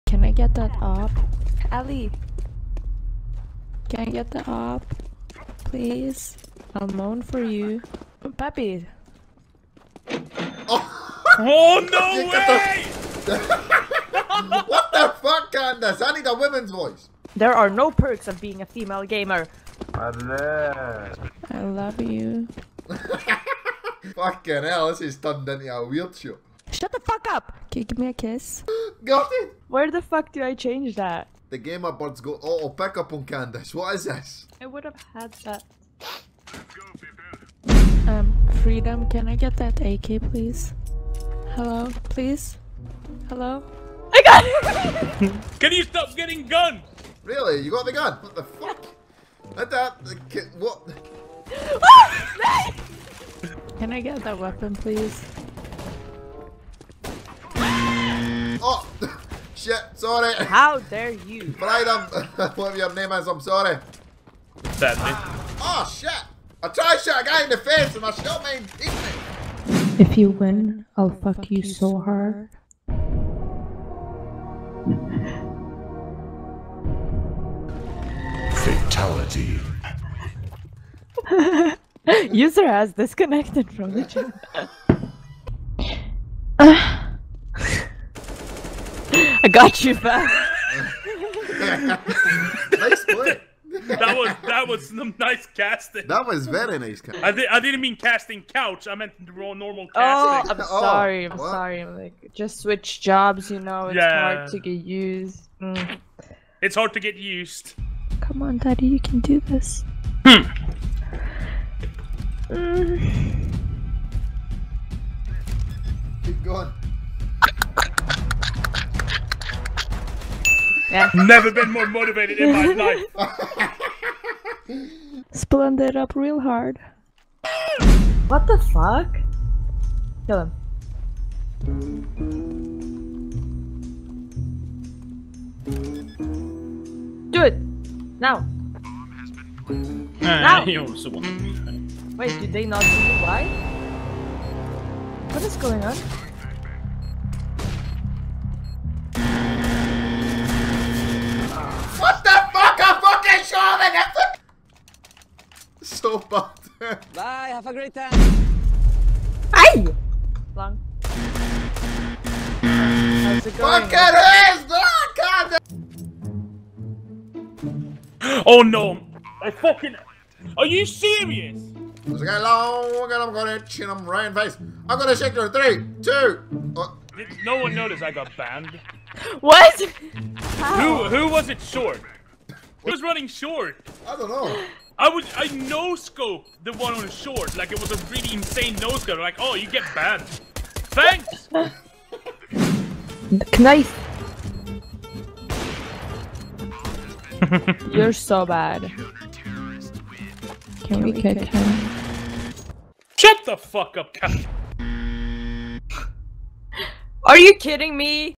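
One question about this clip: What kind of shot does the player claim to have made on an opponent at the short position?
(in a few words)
No scope.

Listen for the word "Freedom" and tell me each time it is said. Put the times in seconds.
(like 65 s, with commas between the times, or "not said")
38 s, 61 s.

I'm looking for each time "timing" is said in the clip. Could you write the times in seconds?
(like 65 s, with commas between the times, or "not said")
not said.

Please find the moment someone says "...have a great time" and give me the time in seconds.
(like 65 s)
157 s.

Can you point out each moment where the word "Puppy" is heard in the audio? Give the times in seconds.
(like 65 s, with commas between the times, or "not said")
8 s.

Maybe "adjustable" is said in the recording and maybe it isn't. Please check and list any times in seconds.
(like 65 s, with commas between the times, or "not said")
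not said.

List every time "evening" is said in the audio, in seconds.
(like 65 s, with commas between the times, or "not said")
68 s.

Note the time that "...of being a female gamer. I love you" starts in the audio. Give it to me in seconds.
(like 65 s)
18 s.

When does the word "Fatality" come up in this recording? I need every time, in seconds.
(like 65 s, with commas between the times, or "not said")
78 s.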